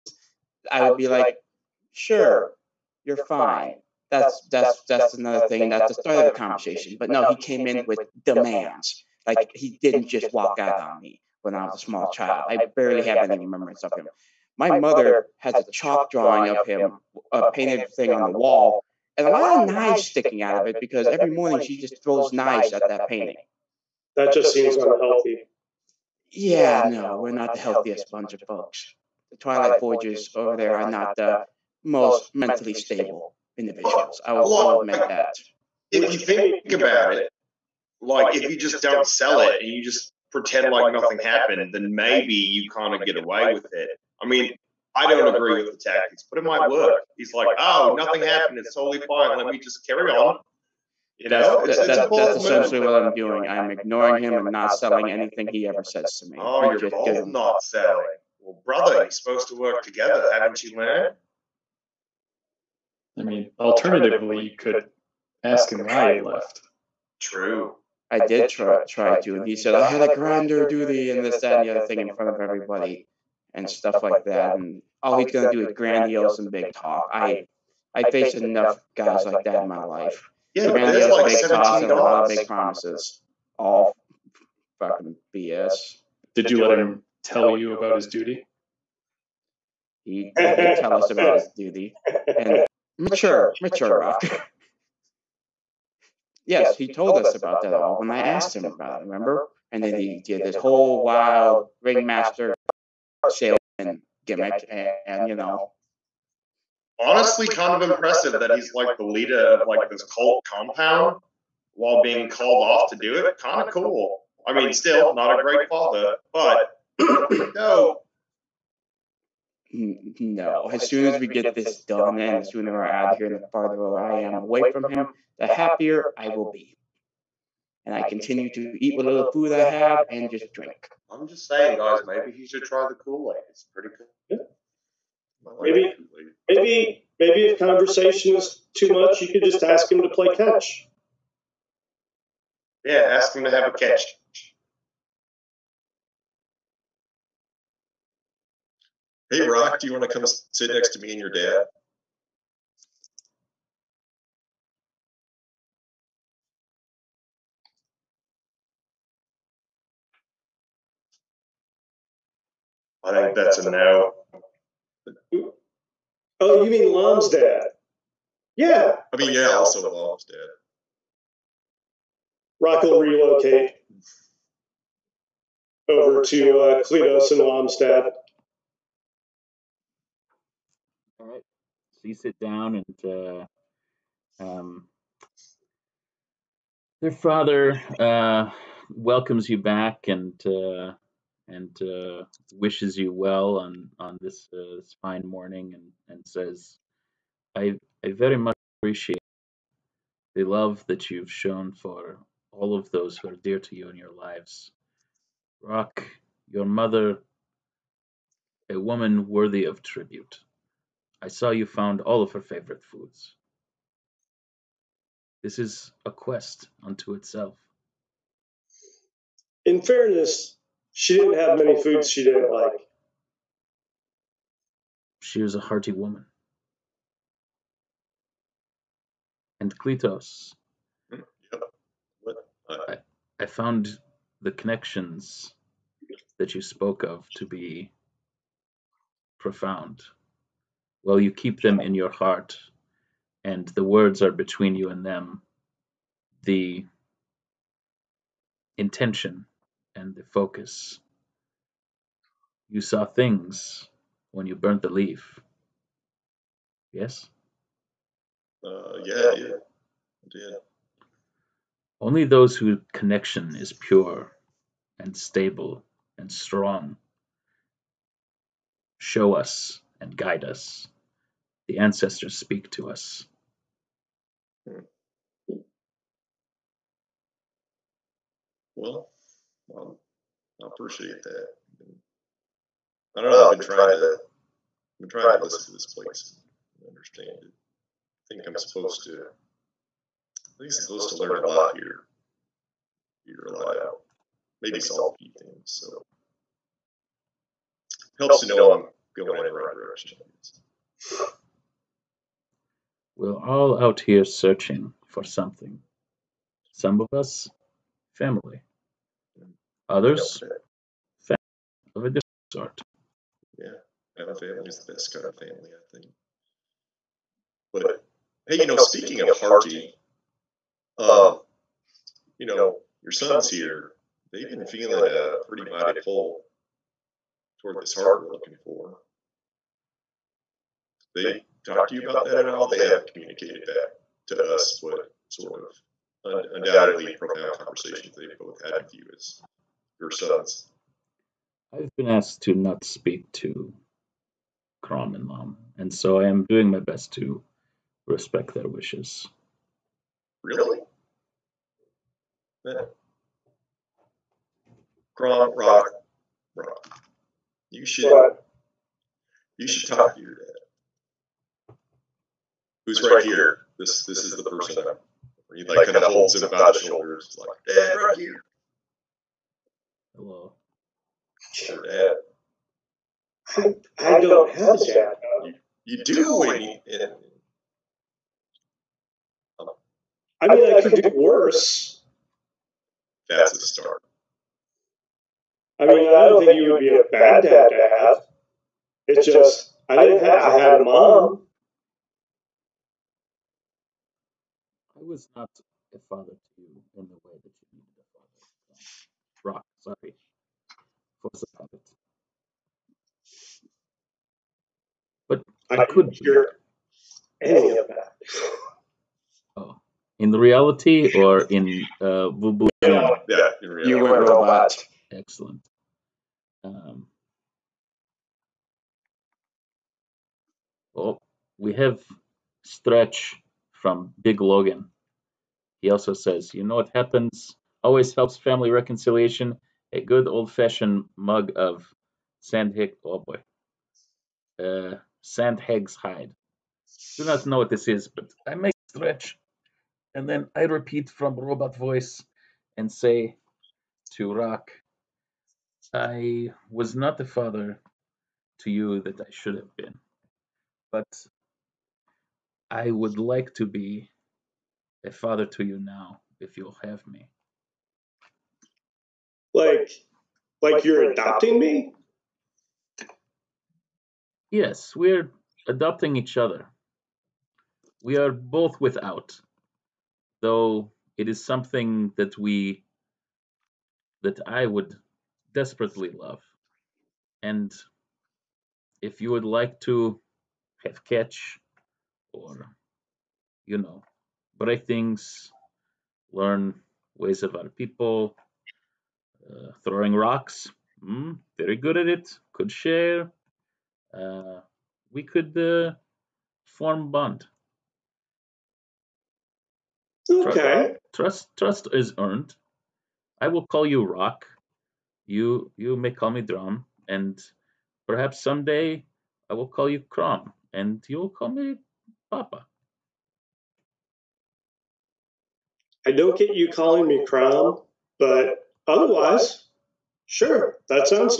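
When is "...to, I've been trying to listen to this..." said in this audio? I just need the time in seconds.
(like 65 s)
283 s.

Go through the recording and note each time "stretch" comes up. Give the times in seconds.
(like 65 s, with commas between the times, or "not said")
422 s, 438 s.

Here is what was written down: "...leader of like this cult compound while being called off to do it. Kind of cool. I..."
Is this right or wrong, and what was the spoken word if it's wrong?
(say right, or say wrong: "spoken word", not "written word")
right.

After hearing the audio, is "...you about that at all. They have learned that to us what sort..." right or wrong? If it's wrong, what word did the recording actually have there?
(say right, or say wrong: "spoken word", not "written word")
wrong: "communicated", not "learned".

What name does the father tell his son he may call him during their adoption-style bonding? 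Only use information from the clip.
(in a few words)
Drum.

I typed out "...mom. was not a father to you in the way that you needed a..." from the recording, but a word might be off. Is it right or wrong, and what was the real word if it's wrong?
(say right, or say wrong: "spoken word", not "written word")
right.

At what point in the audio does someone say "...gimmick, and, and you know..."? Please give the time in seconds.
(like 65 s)
104 s.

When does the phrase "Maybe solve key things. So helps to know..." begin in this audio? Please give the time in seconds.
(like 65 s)
294 s.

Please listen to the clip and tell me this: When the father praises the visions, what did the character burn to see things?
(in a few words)
The leaf.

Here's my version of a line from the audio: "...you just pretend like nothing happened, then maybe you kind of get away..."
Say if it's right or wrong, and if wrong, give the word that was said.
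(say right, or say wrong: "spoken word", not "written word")
right.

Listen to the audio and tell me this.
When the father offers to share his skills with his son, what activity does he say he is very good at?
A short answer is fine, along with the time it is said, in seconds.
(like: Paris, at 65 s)
Throwing rocks, at 489 s.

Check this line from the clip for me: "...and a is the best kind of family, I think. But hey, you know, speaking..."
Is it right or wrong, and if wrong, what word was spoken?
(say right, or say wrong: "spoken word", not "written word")
right.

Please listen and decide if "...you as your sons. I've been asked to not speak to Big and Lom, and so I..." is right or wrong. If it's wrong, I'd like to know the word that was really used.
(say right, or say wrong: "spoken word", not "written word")
wrong: "Kron", not "Big".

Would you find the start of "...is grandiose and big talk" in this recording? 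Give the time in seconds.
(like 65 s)
75 s.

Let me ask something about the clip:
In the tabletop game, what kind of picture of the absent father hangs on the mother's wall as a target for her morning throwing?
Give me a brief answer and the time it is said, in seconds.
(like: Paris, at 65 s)
Chalk drawing, at 15 s.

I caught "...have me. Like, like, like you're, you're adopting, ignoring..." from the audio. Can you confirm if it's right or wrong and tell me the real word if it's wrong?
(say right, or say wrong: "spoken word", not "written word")
wrong: "adopting", not "ignoring".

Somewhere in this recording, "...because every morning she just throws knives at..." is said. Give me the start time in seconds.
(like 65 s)
20 s.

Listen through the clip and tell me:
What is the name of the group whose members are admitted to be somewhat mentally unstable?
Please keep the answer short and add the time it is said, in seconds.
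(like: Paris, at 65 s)
Twilight Voyagers, at 29 s.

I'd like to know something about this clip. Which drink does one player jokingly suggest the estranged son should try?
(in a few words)
Kool Aid.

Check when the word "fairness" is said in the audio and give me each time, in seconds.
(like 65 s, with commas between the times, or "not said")
219 s.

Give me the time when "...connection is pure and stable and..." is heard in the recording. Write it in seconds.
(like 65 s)
262 s.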